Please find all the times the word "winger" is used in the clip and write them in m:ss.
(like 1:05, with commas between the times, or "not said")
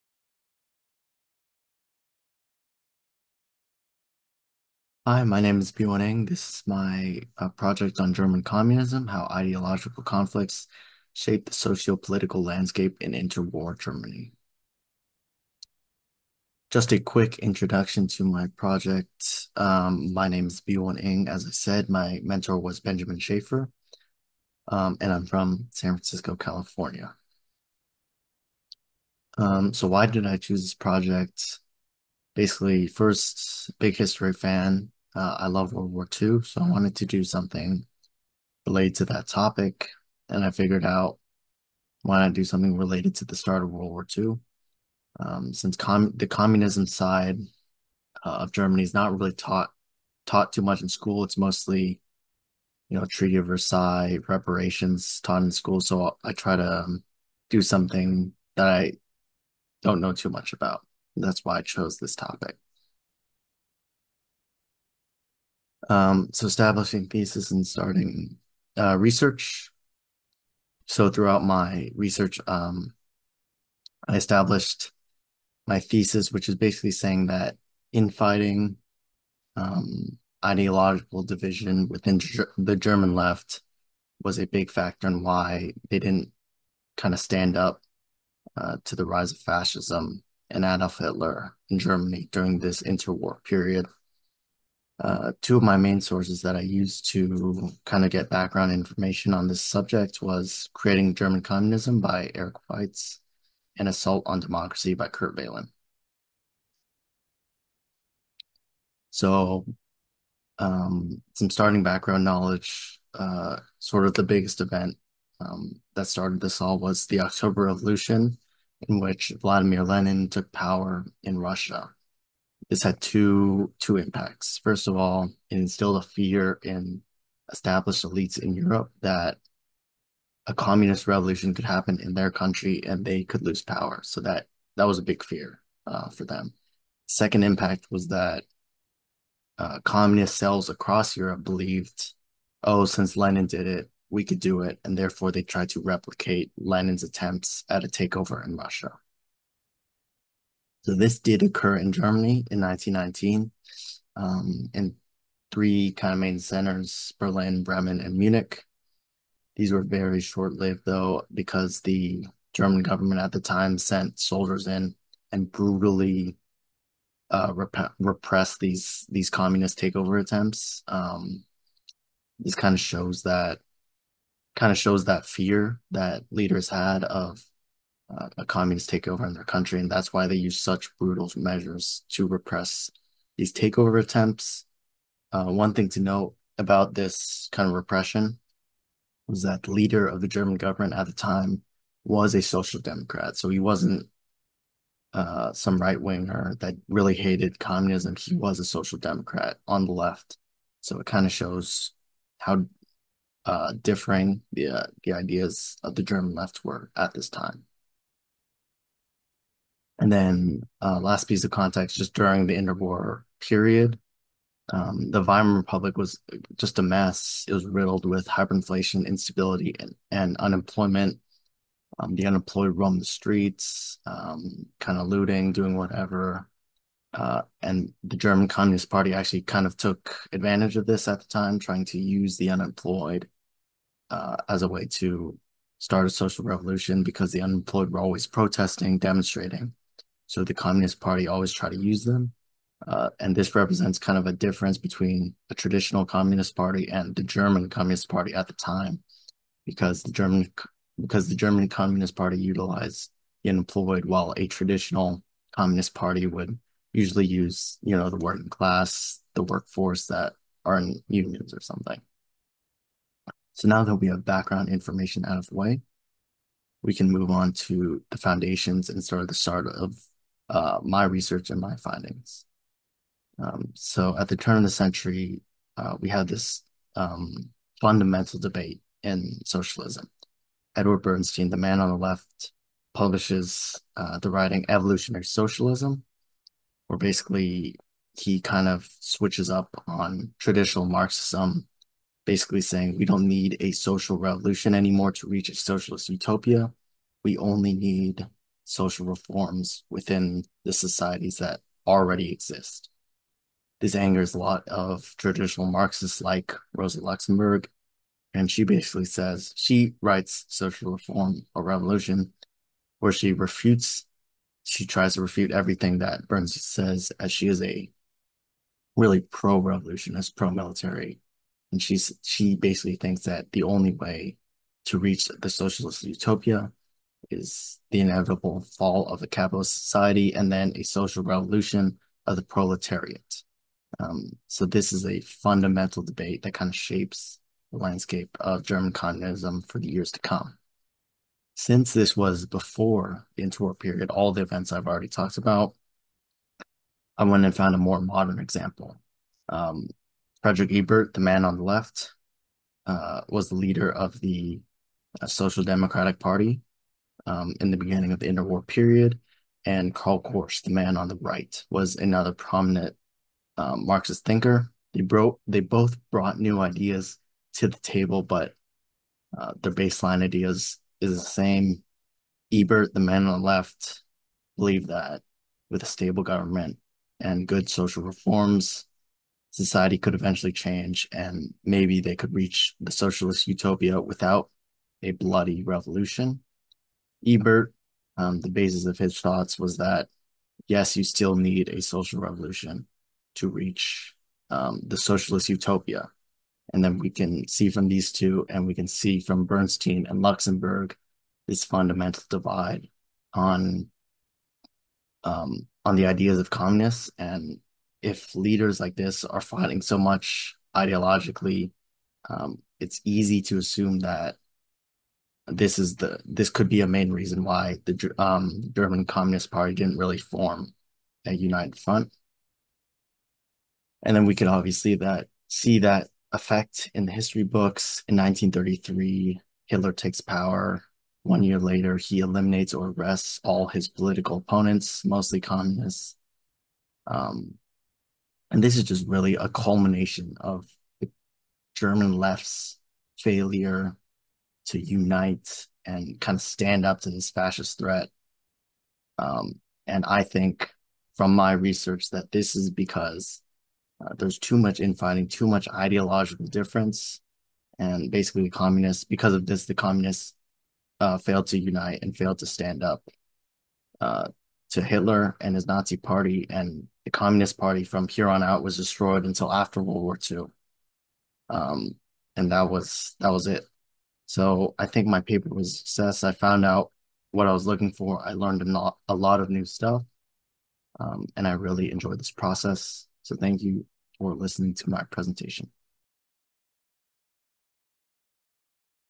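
3:15.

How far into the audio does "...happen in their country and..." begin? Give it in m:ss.
2:11.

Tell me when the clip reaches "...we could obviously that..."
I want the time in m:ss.
7:04.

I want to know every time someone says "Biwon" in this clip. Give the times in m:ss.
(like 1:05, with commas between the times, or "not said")
0:05, 0:20.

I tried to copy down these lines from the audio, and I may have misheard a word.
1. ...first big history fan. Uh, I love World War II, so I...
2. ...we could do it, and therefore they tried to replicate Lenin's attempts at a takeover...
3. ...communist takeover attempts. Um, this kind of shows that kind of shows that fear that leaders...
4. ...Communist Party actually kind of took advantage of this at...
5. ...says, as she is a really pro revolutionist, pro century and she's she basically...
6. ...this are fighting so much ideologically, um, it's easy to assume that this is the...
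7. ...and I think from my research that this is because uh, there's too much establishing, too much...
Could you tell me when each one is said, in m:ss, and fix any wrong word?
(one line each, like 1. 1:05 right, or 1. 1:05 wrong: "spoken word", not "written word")
1. 0:32 right
2. 2:24 right
3. 2:49 right
4. 3:48 right
5. 5:16 wrong: "military", not "century"
6. 6:48 right
7. 7:29 wrong: "infighting", not "establishing".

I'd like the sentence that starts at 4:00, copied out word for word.
So the Communist Party always tried to use them.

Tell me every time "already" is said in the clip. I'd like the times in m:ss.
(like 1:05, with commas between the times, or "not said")
5:01, 5:44.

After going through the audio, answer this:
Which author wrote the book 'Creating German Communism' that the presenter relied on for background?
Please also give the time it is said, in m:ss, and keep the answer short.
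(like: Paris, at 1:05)
Eric Weitz, at 1:42.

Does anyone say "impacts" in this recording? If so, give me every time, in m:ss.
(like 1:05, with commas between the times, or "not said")
2:03, 2:17.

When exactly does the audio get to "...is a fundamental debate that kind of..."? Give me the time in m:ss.
5:34.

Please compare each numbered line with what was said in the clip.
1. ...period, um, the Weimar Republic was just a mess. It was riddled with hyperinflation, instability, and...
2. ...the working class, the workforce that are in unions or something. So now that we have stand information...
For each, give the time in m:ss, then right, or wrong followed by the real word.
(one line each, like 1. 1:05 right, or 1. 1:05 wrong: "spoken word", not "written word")
1. 3:33 right
2. 4:18 wrong: "background", not "stand".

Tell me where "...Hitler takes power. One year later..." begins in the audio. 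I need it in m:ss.
7:09.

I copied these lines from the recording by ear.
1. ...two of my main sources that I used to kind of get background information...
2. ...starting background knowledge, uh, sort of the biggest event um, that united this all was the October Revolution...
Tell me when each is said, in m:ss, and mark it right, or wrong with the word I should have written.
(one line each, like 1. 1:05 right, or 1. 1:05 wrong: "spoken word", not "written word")
1. 1:35 right
2. 1:51 wrong: "started", not "united".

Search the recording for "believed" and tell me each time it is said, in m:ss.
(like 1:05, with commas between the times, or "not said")
2:21, 6:14.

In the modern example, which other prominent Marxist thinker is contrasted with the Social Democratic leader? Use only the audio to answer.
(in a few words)
Karl Korsch.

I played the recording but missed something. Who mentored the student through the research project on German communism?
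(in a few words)
Benjamin Schaefer.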